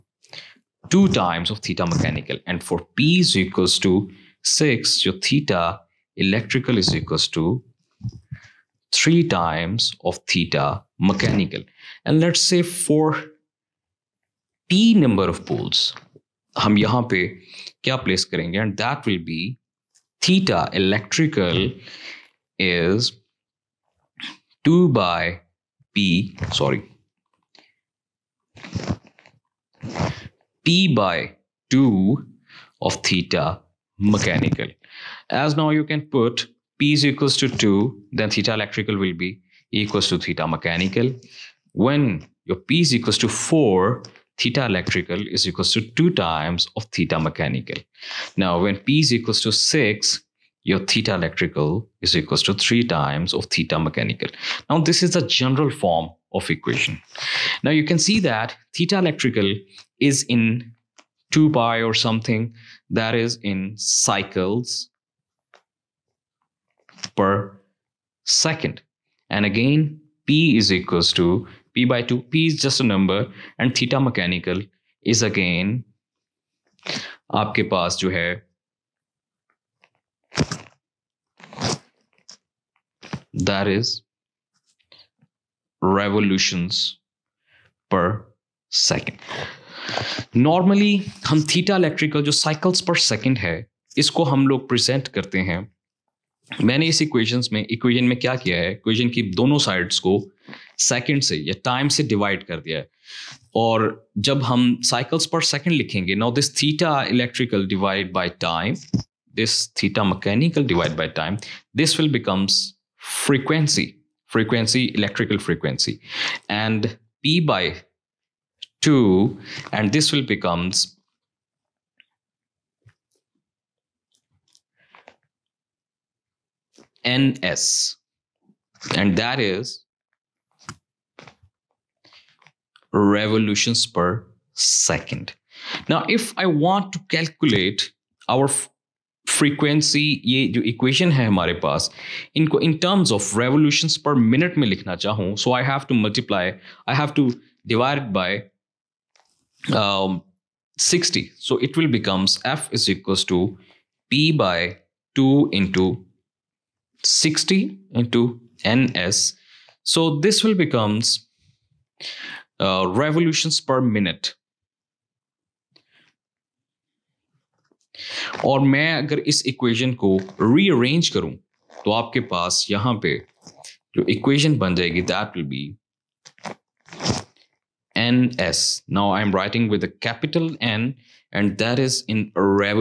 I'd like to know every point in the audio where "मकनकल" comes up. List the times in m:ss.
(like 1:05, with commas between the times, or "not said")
1:50.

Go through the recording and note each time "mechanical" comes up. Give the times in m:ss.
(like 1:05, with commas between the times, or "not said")
0:01, 0:10, 0:34, 0:40, 0:47, 0:53, 1:13.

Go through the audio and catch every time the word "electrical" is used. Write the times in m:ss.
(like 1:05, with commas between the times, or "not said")
0:06, 0:20, 0:38, 0:44, 0:51, 0:58, 1:31.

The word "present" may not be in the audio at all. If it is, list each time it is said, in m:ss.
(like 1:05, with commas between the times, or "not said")
1:34.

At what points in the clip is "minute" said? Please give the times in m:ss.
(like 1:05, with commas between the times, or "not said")
2:24, 2:43.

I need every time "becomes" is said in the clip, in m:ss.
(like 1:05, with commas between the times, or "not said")
2:31, 2:40.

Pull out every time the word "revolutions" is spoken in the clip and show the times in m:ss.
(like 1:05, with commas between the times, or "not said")
1:25, 2:12, 2:23, 2:42.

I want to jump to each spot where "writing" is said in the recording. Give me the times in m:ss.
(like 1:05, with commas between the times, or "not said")
2:59.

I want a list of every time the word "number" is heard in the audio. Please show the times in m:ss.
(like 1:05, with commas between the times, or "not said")
0:14, 1:12.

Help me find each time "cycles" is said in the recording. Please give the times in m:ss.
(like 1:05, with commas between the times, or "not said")
1:03, 1:32.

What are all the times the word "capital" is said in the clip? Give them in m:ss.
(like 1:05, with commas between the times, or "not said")
3:00.